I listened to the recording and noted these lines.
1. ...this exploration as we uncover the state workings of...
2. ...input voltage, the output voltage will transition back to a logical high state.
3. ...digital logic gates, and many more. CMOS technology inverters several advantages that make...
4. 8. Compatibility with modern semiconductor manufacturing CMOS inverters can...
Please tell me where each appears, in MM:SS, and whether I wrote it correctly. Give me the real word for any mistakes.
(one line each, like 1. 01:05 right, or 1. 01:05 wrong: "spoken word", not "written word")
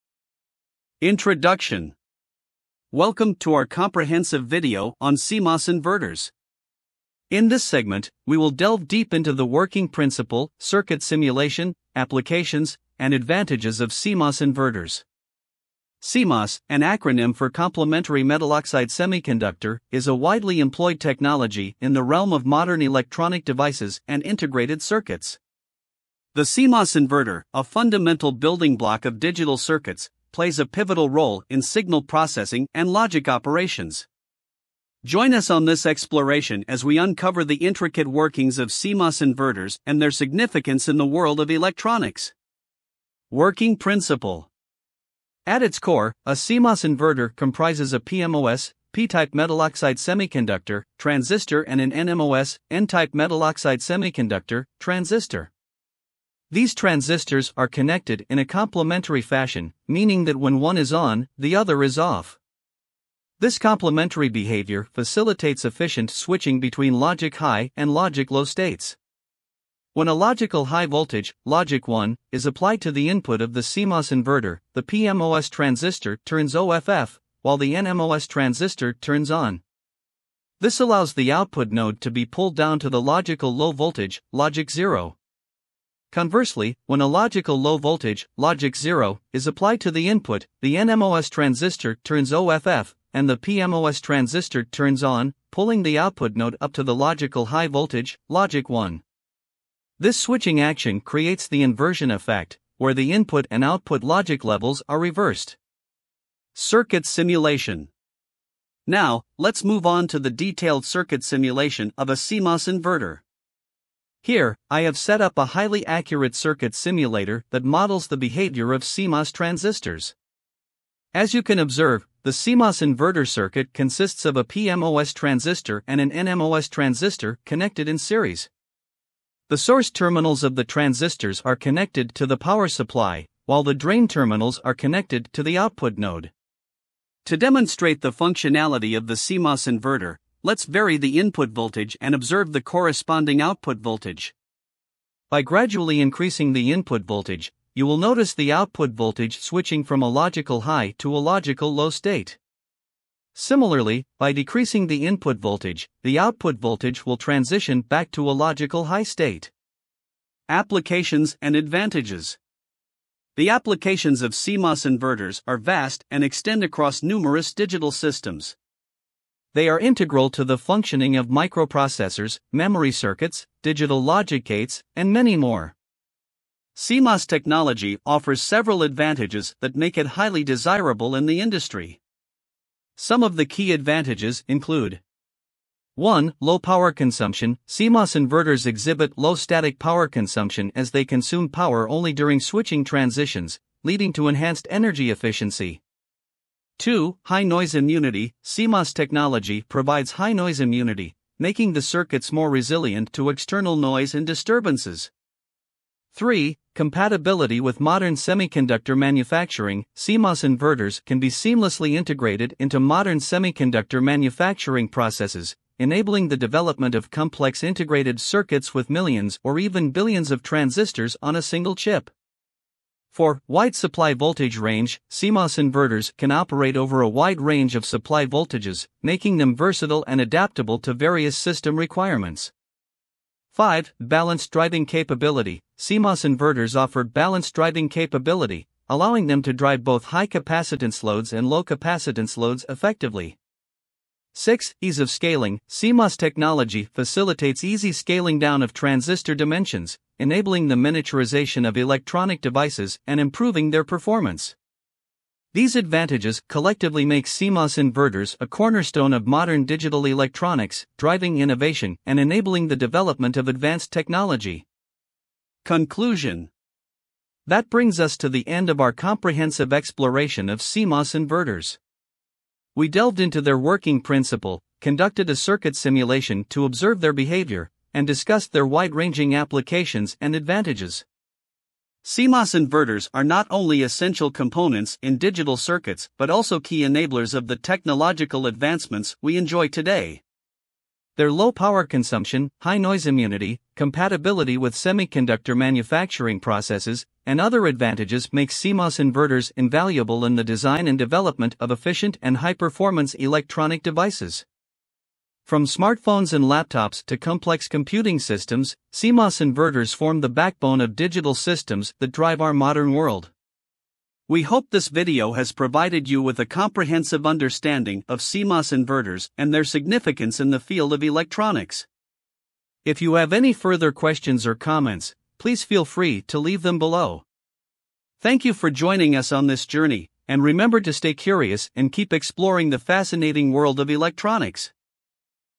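1. 00:35 wrong: "intricate", not "state"
2. 02:35 right
3. 02:53 wrong: "offers", not "inverters"
4. 03:26 wrong: "3", not "8".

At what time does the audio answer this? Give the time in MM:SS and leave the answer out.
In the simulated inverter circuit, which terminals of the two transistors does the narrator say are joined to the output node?
02:13.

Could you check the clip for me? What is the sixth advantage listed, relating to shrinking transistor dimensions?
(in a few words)
Ease of scaling.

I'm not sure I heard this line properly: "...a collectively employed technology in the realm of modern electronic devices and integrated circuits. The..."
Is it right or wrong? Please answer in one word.
wrong.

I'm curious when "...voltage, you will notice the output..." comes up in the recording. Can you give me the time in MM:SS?
02:27.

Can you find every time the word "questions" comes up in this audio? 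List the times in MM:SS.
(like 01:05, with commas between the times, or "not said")
05:23.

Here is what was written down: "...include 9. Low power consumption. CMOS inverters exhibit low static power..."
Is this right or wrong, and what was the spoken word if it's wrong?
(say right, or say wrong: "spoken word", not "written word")
wrong: "1", not "9".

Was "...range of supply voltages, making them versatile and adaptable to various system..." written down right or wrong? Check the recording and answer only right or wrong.
right.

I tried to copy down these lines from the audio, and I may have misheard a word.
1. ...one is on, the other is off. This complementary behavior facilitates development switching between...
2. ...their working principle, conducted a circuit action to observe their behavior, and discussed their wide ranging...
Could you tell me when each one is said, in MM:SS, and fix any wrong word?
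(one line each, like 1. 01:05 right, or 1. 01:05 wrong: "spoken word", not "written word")
1. 01:00 wrong: "efficient", not "development"
2. 04:33 wrong: "simulation", not "action".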